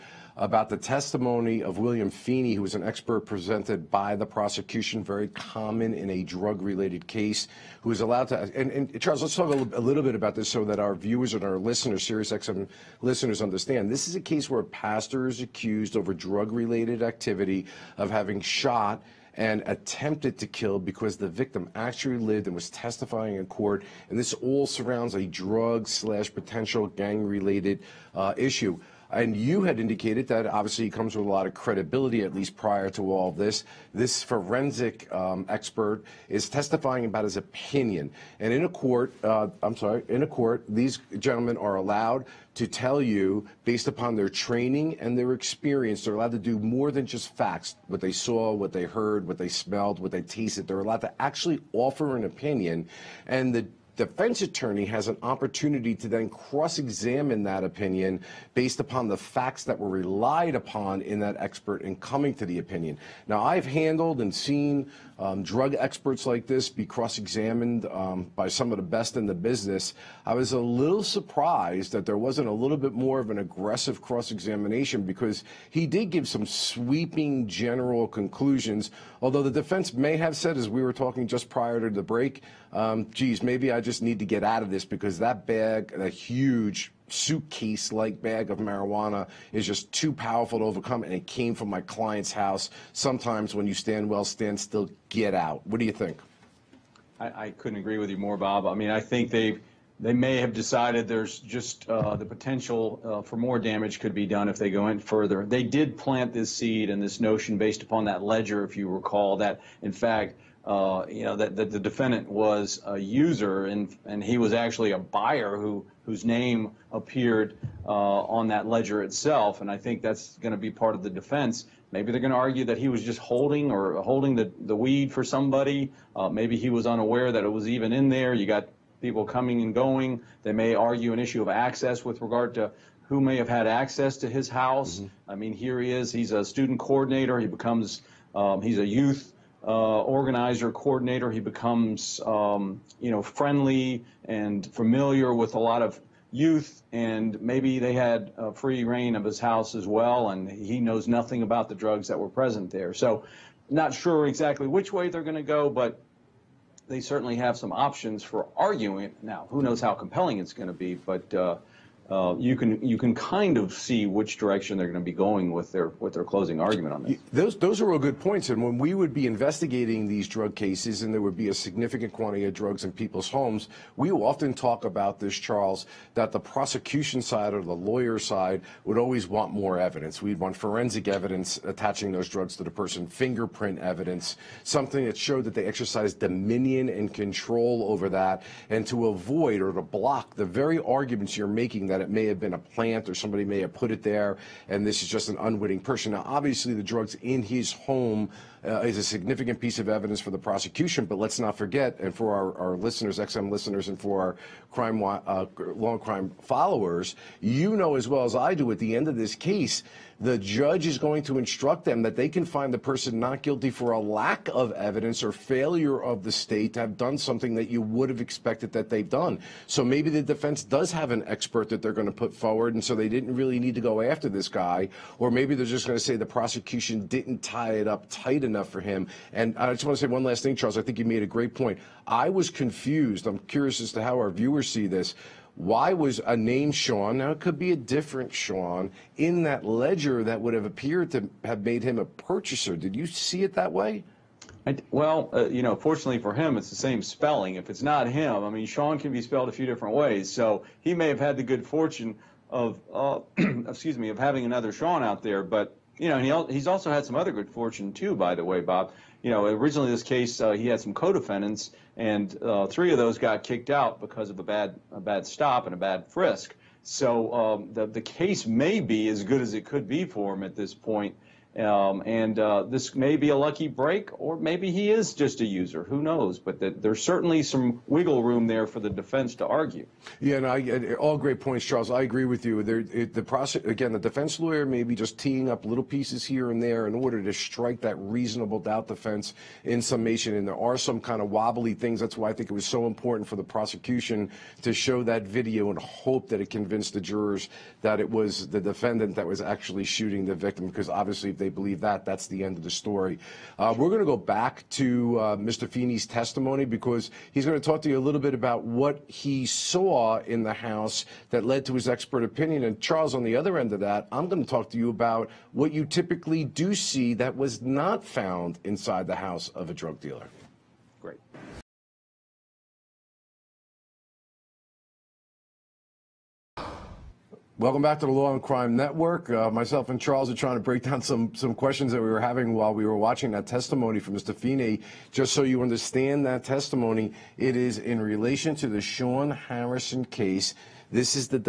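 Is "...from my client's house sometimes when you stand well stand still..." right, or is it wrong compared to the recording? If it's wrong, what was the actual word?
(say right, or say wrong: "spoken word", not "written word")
right.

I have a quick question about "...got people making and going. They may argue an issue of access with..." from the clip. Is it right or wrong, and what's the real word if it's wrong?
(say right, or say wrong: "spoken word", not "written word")
wrong: "coming", not "making".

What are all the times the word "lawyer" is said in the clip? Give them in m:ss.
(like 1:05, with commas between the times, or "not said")
2:57, 4:44.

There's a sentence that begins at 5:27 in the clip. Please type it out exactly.
Welcome back to the Law and Crime Network.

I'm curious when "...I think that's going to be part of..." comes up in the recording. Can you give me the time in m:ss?
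1:59.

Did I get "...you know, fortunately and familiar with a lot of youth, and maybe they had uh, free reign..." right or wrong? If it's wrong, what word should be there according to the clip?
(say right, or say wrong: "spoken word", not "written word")
wrong: "friendly", not "fortunately".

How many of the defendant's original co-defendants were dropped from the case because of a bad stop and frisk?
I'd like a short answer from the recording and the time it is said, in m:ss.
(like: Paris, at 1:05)
3, at 4:22.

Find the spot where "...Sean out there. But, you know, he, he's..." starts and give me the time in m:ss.
4:14.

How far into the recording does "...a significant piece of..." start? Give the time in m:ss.
3:18.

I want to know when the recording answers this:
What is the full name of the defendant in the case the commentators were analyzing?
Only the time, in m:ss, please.
5:38.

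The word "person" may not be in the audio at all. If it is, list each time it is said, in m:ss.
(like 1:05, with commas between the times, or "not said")
3:02, 3:15, 3:32.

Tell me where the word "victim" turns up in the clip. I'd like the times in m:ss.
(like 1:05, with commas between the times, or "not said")
0:21, 5:00.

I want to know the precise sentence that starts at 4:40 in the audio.
Yeah, no, I, all great points, Charles.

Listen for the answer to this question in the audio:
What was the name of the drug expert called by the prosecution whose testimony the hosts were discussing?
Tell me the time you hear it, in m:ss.
0:01.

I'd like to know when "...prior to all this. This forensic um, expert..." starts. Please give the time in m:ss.
0:32.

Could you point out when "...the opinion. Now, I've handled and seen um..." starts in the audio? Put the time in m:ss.
1:02.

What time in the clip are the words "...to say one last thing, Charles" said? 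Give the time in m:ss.
3:49.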